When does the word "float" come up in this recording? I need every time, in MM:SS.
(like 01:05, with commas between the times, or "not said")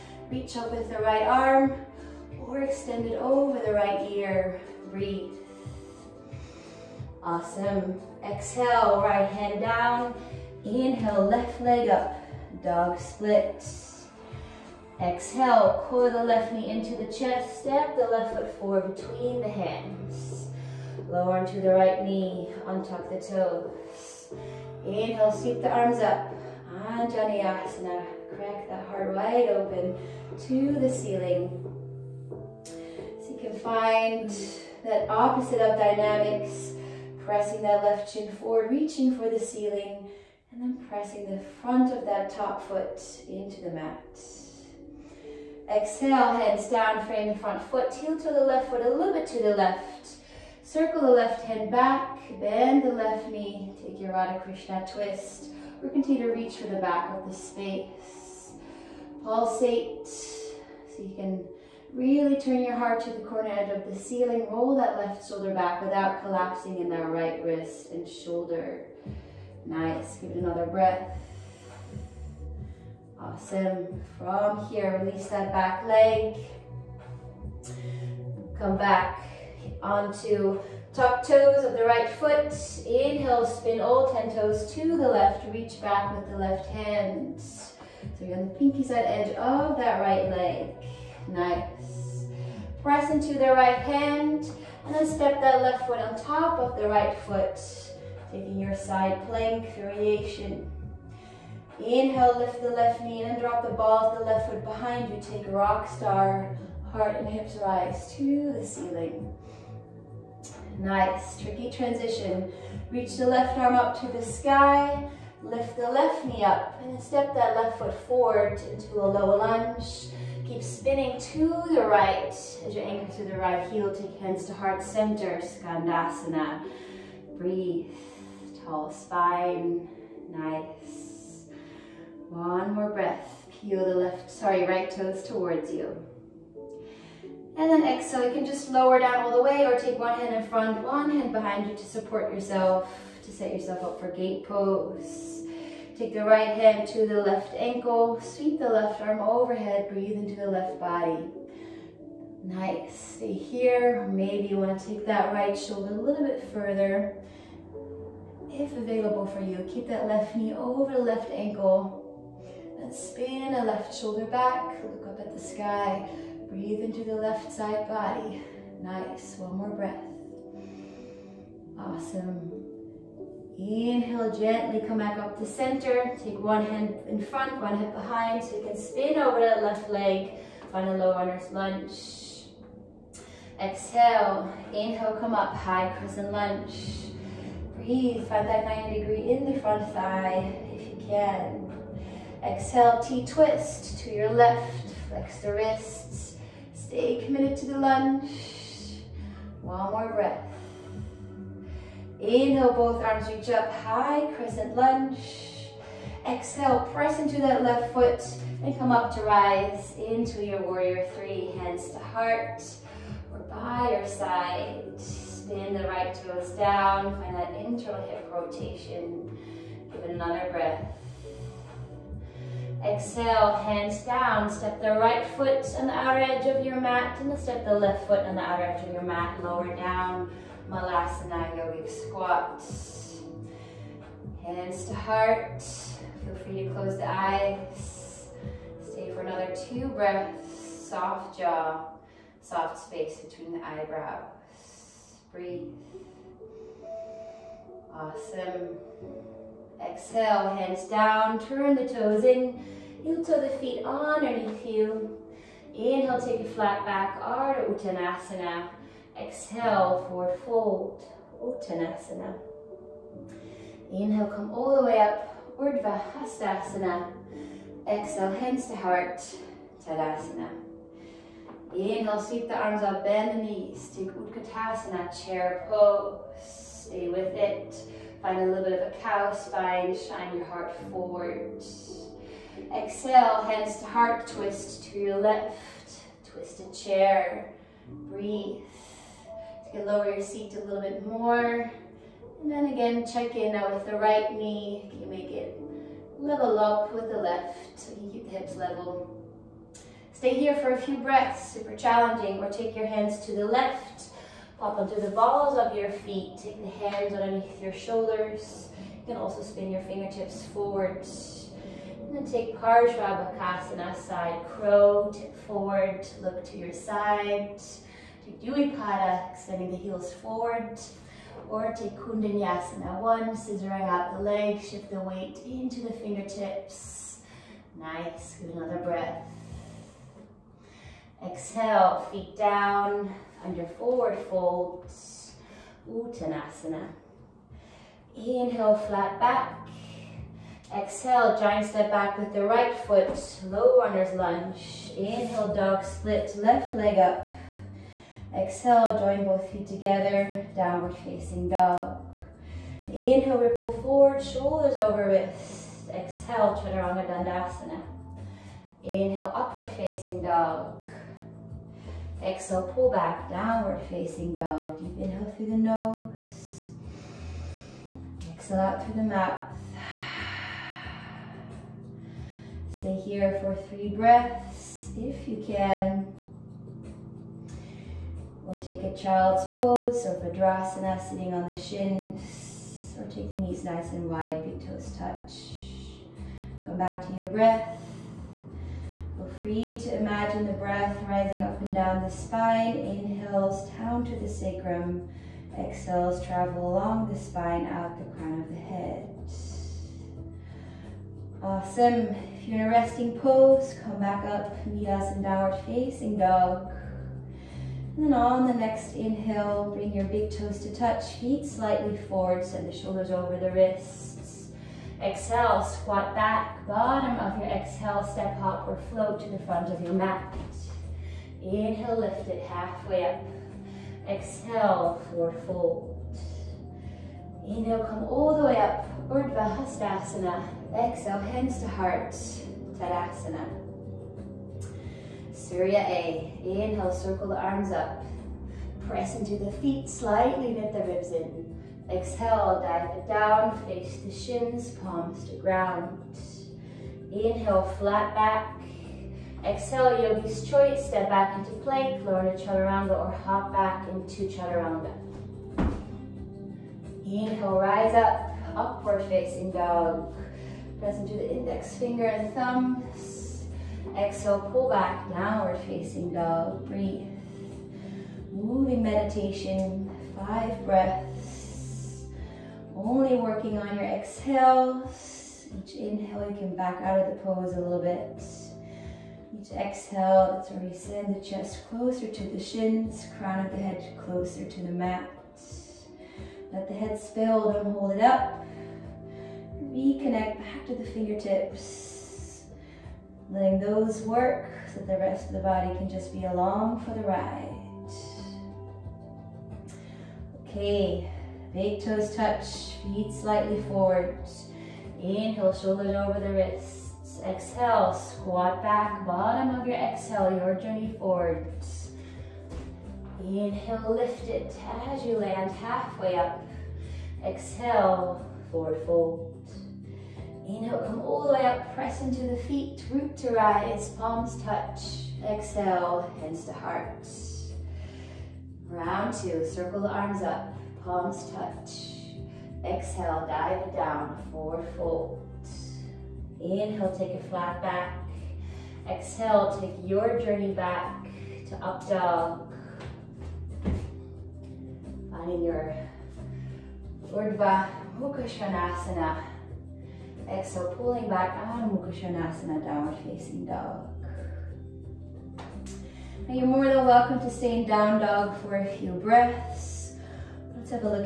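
06:58.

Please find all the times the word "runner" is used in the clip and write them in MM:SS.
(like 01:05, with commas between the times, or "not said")
03:01, 05:43.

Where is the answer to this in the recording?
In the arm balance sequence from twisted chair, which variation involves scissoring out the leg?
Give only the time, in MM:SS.
05:21.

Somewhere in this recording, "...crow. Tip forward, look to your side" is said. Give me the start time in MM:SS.
05:14.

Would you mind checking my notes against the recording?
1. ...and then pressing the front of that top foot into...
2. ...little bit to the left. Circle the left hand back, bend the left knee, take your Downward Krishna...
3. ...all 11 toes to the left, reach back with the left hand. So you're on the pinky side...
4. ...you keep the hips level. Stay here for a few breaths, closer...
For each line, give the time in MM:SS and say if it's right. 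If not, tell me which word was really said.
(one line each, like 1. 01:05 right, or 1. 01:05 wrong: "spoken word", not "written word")
1. 00:40 right
2. 00:48 wrong: "Radha", not "Downward"
3. 01:23 wrong: "10", not "11"
4. 04:57 wrong: "super", not "closer".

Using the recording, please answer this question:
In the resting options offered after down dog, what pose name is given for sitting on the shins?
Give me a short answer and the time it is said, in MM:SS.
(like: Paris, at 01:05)
Padrasana, at 06:20.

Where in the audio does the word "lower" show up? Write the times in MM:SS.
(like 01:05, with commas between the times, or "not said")
00:21, 02:18, 03:49, 04:49, 07:32.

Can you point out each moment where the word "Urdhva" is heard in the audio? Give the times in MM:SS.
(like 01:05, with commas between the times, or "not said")
04:25, 07:09, 09:07.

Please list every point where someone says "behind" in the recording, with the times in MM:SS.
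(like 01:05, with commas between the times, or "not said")
01:44, 02:21, 02:57.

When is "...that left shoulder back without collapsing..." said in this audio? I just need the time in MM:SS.
01:04.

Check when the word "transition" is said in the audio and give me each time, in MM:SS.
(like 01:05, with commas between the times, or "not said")
01:51.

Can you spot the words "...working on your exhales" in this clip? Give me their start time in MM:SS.
07:53.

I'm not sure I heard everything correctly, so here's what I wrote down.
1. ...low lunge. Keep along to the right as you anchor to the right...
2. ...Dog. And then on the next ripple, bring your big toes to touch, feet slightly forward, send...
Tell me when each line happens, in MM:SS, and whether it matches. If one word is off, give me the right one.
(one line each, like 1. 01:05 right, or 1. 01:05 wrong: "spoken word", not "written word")
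1. 01:59 wrong: "spinning", not "along"
2. 06:46 wrong: "inhale", not "ripple".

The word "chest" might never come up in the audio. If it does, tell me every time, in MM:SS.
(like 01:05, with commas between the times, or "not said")
00:17, 08:01.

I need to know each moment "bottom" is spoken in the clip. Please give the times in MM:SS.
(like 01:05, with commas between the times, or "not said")
06:56, 08:29.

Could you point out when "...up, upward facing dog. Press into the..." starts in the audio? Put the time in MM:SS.
07:37.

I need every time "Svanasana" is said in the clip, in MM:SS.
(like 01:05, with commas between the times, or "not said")
09:11.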